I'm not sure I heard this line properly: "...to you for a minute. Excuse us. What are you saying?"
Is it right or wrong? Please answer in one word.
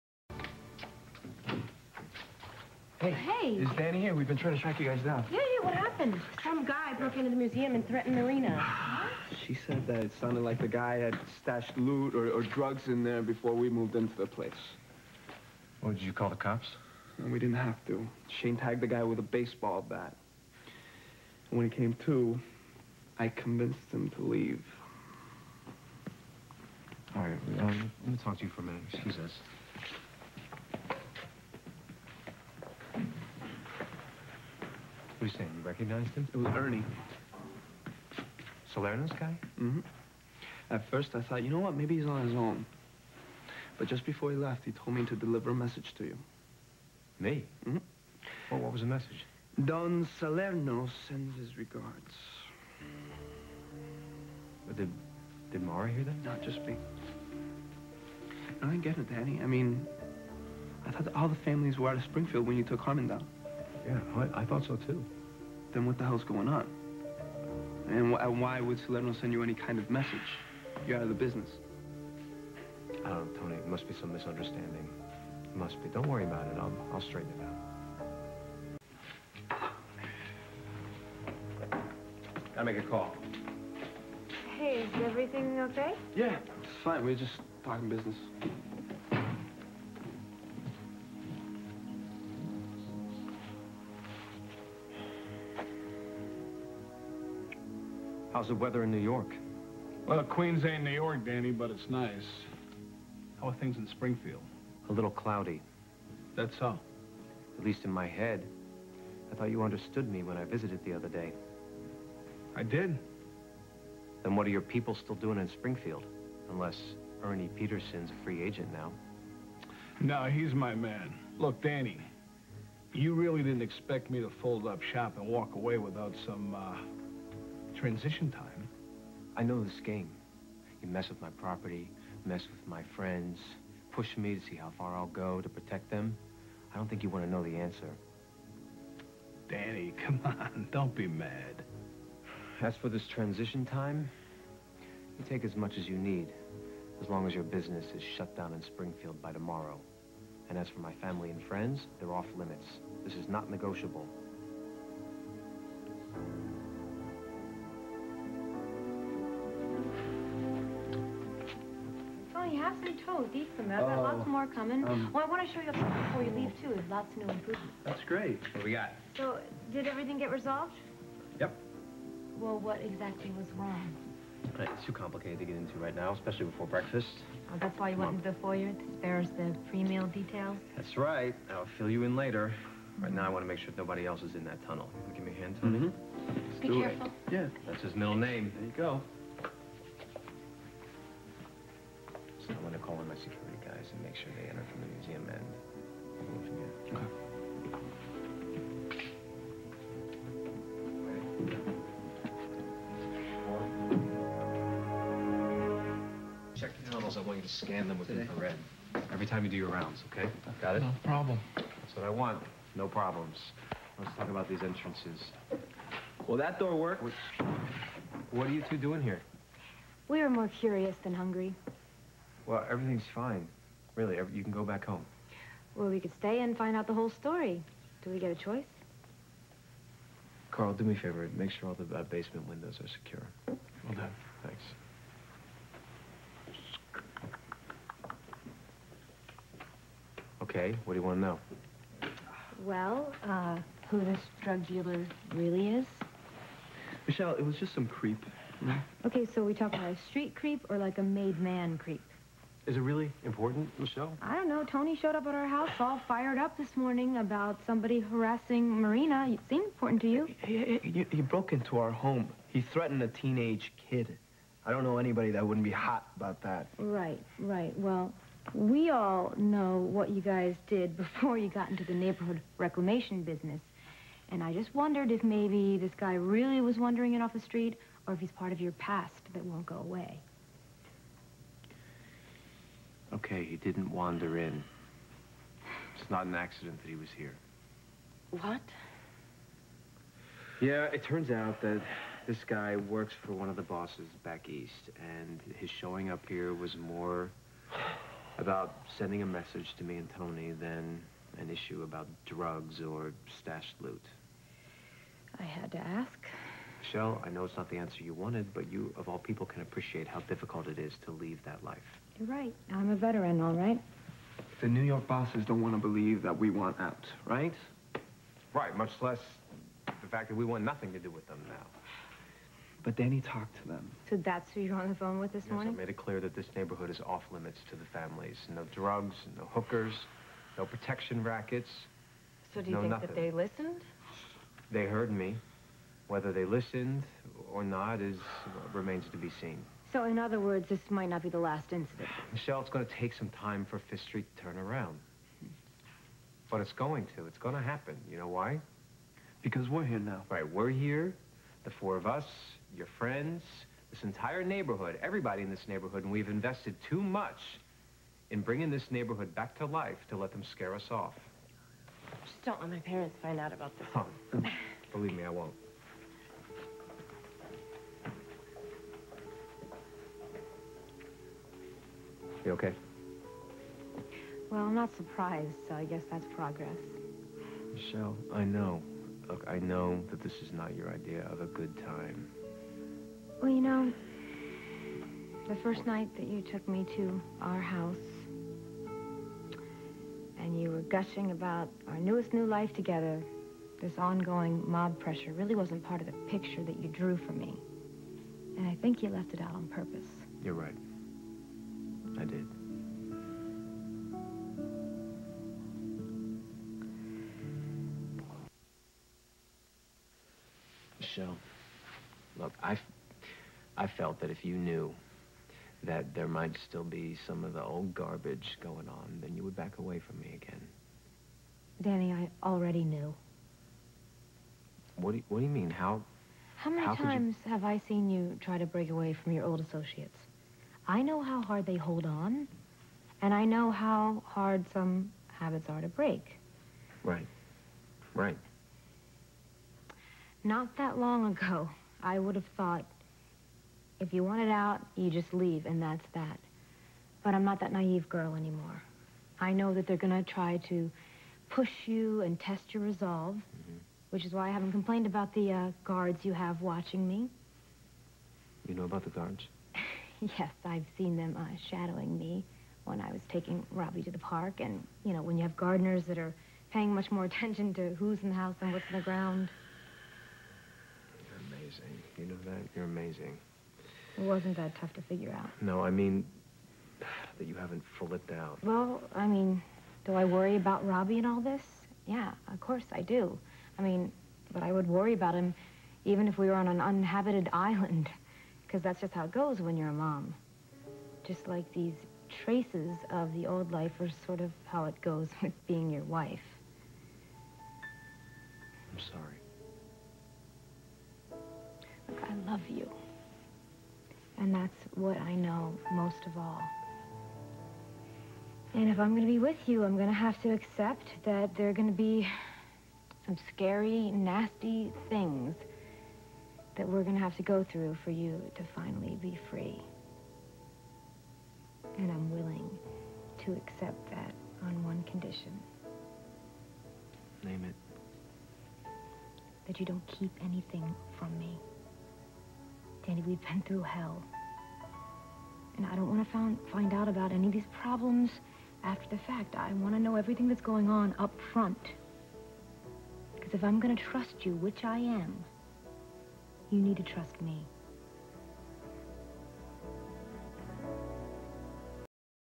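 right.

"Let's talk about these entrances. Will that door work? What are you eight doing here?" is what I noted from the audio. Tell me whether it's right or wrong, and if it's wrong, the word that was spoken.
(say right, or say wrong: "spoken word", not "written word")
wrong: "two", not "eight".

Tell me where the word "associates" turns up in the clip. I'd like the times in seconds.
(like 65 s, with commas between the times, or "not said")
429 s.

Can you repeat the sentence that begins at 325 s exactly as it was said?
I made it clear that this neighborhood is off limits to the families.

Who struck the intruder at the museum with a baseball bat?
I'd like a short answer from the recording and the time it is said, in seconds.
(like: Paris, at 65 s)
Shane, at 18 s.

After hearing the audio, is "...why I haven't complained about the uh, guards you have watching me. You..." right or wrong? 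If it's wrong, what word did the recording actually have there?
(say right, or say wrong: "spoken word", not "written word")
right.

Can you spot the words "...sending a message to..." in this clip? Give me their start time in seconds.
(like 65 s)
298 s.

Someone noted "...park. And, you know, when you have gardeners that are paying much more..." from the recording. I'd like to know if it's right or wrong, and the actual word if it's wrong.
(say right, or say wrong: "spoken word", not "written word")
right.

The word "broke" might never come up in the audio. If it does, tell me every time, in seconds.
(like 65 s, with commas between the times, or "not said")
6 s, 261 s.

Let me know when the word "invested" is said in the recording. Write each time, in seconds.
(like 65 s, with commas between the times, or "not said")
356 s.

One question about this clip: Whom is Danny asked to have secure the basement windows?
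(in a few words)
Carl.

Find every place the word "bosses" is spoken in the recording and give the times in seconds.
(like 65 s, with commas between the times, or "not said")
293 s, 315 s.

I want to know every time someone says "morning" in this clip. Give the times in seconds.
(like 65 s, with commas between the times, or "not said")
256 s, 325 s.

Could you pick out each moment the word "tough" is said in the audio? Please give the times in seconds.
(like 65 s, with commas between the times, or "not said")
474 s.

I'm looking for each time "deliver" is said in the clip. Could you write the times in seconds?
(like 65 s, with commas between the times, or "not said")
45 s.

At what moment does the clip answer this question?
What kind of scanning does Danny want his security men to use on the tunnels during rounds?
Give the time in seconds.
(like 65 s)
208 s.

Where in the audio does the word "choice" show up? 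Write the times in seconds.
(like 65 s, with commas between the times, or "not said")
228 s.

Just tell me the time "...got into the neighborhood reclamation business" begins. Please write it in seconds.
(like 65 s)
271 s.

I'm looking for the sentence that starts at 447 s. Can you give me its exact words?
But I'm not that naive girl anymore.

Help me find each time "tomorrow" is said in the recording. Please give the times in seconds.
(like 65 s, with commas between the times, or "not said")
149 s.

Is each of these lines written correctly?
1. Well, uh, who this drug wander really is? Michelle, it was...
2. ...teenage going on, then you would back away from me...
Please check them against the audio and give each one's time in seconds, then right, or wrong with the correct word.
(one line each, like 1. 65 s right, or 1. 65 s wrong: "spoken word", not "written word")
1. 242 s wrong: "dealer", not "wander"
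2. 417 s wrong: "garbage", not "teenage".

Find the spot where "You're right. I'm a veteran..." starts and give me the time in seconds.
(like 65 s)
312 s.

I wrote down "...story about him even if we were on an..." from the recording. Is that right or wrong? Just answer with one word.
wrong.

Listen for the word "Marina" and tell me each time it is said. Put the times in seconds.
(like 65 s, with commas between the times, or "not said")
8 s, 258 s.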